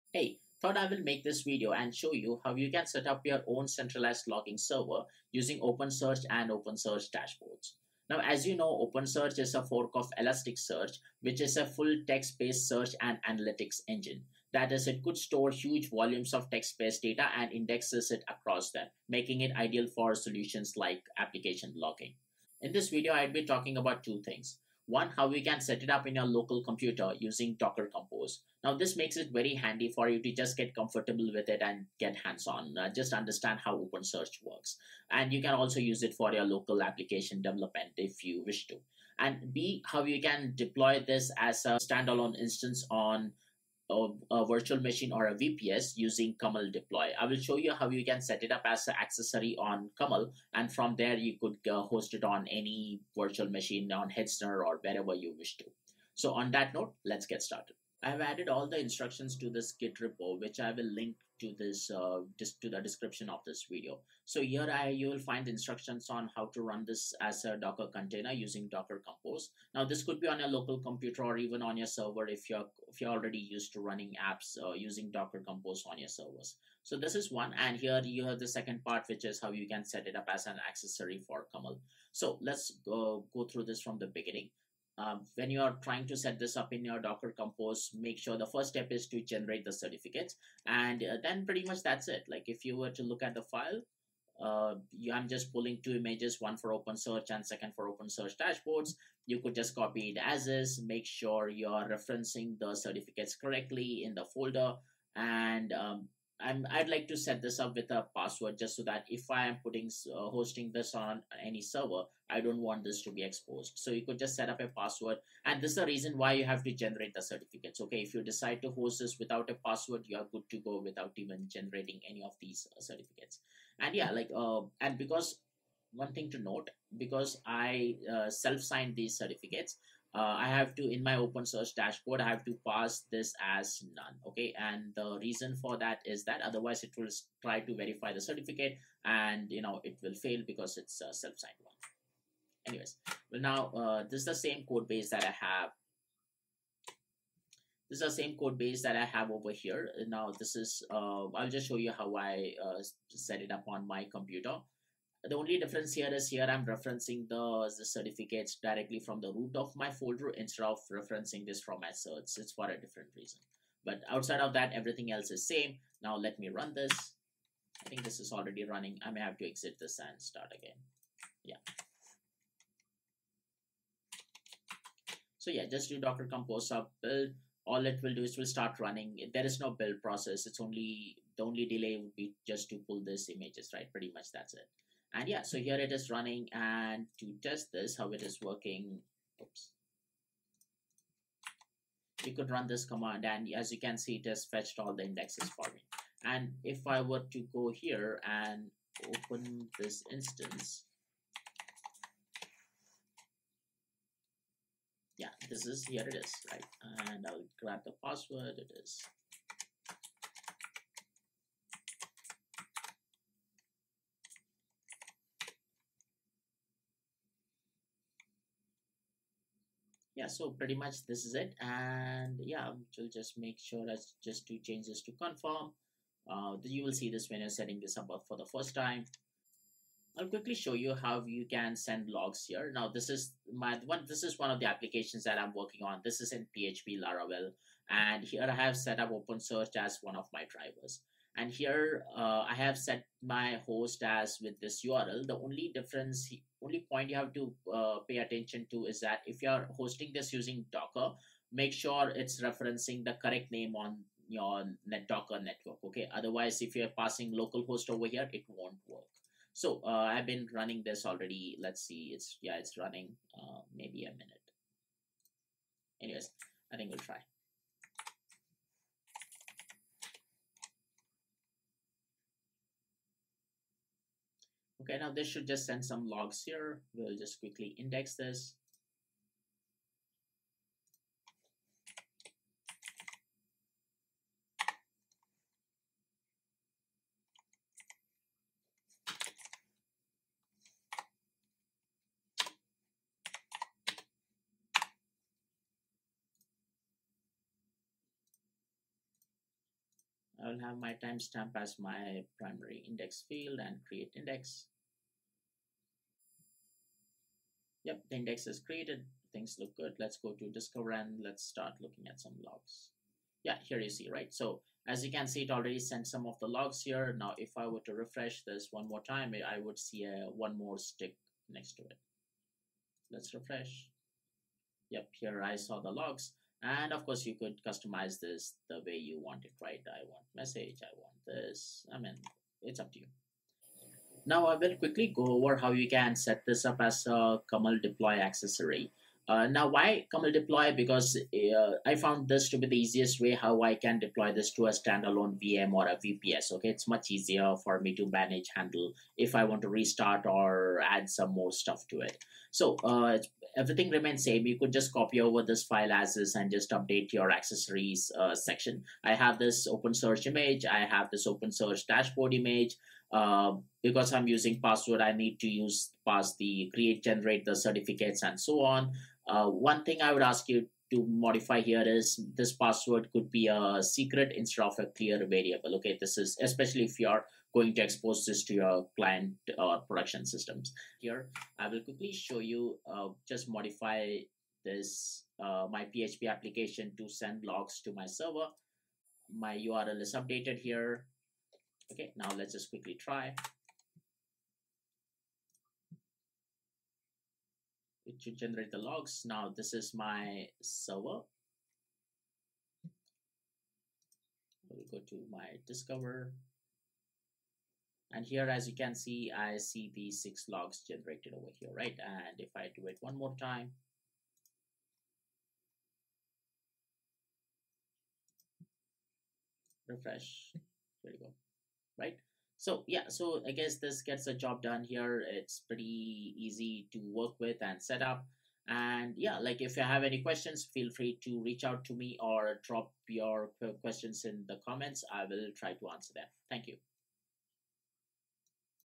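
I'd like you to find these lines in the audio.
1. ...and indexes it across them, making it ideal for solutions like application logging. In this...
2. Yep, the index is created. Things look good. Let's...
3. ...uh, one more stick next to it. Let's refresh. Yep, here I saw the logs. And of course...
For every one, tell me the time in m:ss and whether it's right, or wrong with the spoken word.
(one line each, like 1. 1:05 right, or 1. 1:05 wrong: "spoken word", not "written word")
1. 0:17 right
2. 5:07 right
3. 5:20 right.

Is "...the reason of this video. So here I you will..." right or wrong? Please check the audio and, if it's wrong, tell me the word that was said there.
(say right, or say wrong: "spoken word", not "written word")
wrong: "description", not "reason".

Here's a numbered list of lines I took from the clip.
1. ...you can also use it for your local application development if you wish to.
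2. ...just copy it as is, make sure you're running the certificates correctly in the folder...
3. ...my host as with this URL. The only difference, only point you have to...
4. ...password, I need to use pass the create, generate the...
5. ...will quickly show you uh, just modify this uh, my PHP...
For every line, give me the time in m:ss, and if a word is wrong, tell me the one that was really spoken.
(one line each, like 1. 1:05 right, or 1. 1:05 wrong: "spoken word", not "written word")
1. 0:35 right
2. 1:39 wrong: "referencing", not "running"
3. 4:03 right
4. 6:04 right
5. 6:21 right.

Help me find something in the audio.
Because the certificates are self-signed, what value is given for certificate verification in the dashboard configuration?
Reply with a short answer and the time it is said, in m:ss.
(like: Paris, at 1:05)
none, at 2:13.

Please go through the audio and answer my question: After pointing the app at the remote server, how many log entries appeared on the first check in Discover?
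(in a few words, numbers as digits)
6.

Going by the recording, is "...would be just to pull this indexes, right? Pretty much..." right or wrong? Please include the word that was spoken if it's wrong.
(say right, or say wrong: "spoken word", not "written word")
wrong: "images", not "indexes".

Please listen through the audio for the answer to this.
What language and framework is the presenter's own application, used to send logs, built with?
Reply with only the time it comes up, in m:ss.
3:56.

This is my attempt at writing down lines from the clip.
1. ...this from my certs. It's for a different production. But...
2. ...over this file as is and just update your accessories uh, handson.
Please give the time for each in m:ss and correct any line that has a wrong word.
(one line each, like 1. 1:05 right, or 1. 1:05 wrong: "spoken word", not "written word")
1. 2:41 wrong: "reason", not "production"
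2. 5:55 wrong: "section", not "handson".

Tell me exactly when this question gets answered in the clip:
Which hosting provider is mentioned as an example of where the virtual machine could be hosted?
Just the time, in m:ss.
0:54.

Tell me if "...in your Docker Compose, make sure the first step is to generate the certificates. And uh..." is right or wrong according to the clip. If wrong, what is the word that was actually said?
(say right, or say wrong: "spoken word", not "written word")
right.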